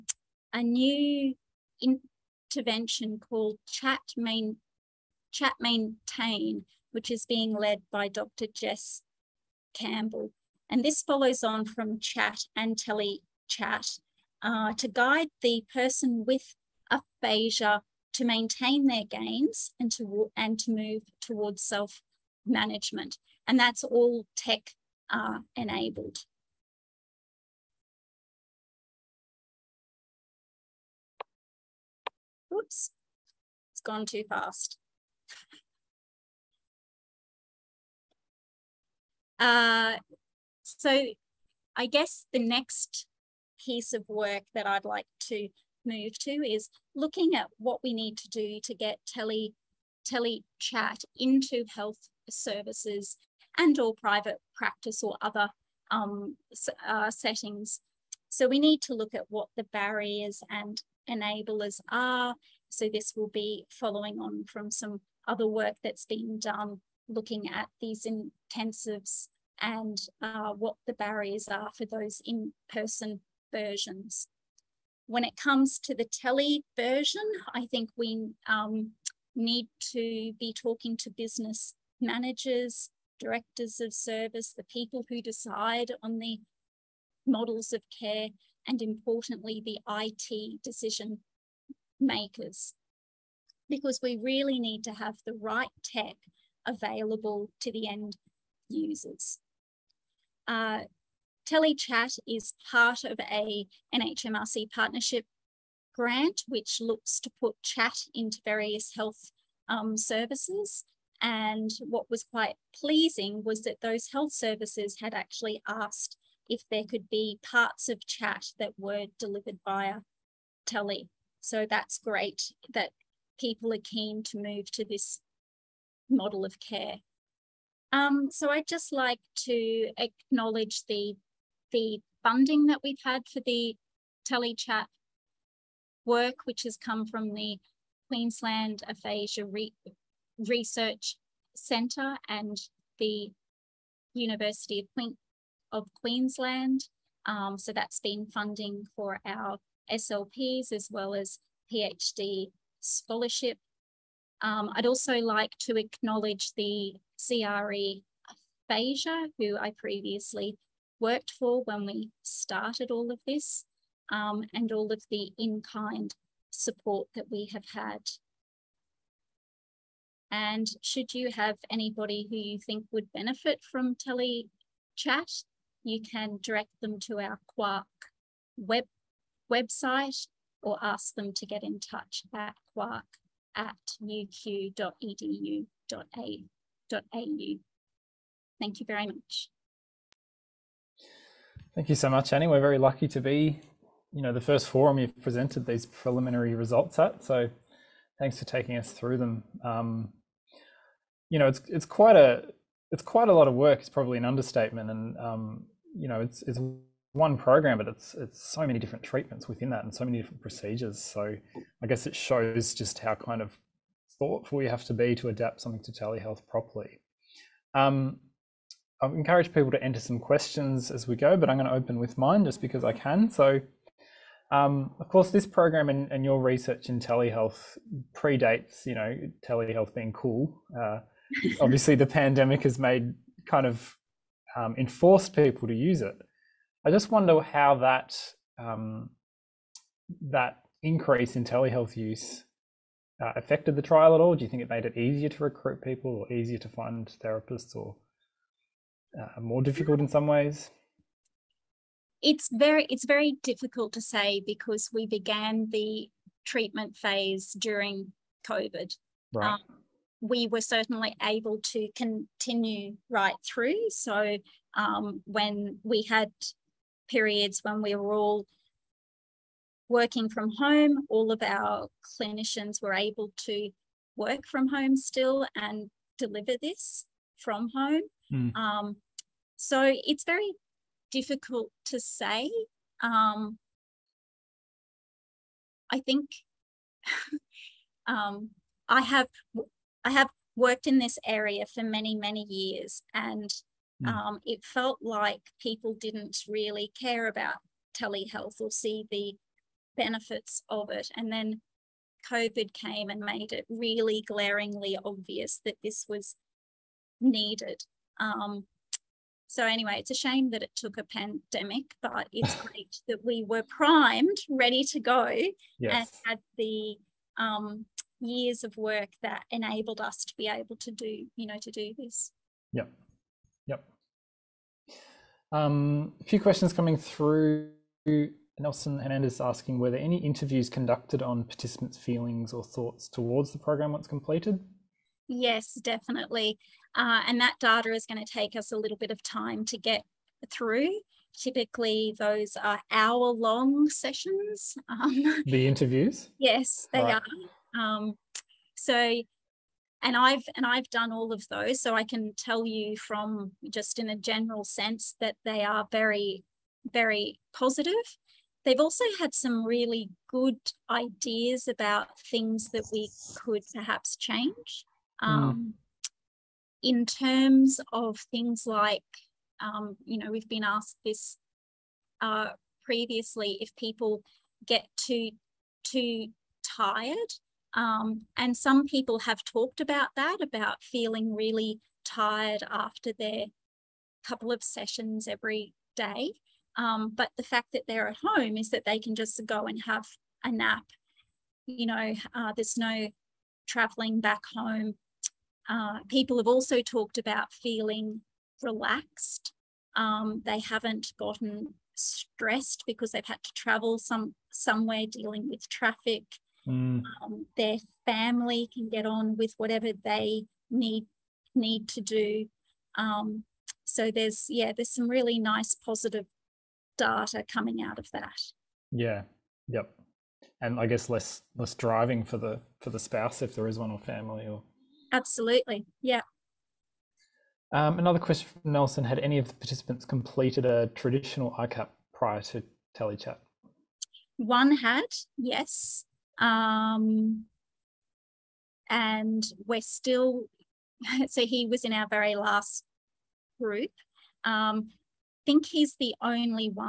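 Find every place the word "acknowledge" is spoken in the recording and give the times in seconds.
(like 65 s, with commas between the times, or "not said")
129 s, 155 s.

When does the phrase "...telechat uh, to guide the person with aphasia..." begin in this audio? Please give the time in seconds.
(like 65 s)
12 s.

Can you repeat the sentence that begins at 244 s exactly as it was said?
Do you think it made it easier to recruit people, or easier to find therapists, or uh, more difficult in some ways?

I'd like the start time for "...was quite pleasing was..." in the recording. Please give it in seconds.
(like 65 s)
112 s.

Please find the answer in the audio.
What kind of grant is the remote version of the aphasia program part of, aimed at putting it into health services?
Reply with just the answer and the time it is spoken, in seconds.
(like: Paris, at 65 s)
NHMRC partnership grant, at 103 s.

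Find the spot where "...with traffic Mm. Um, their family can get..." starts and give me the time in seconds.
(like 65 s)
405 s.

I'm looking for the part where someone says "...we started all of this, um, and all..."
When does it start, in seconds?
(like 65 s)
161 s.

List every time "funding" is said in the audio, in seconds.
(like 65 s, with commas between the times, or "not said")
132 s, 148 s.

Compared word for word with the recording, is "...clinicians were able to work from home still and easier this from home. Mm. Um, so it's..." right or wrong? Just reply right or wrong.
wrong.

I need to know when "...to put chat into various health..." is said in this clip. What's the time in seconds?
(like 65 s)
107 s.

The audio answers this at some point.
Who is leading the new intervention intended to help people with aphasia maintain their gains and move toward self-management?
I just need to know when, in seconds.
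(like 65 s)
8 s.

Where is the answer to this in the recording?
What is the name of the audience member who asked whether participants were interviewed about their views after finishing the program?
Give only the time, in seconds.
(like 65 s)
328 s.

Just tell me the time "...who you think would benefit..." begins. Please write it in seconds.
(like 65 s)
172 s.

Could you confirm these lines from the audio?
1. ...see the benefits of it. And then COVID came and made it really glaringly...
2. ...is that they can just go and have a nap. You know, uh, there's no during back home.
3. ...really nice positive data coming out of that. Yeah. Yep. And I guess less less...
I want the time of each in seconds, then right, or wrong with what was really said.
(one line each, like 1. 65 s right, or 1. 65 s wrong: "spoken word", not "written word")
1. 298 s right
2. 388 s wrong: "traveling", not "during"
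3. 415 s right.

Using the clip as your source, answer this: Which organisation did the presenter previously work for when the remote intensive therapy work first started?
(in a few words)
CRE Aphasia.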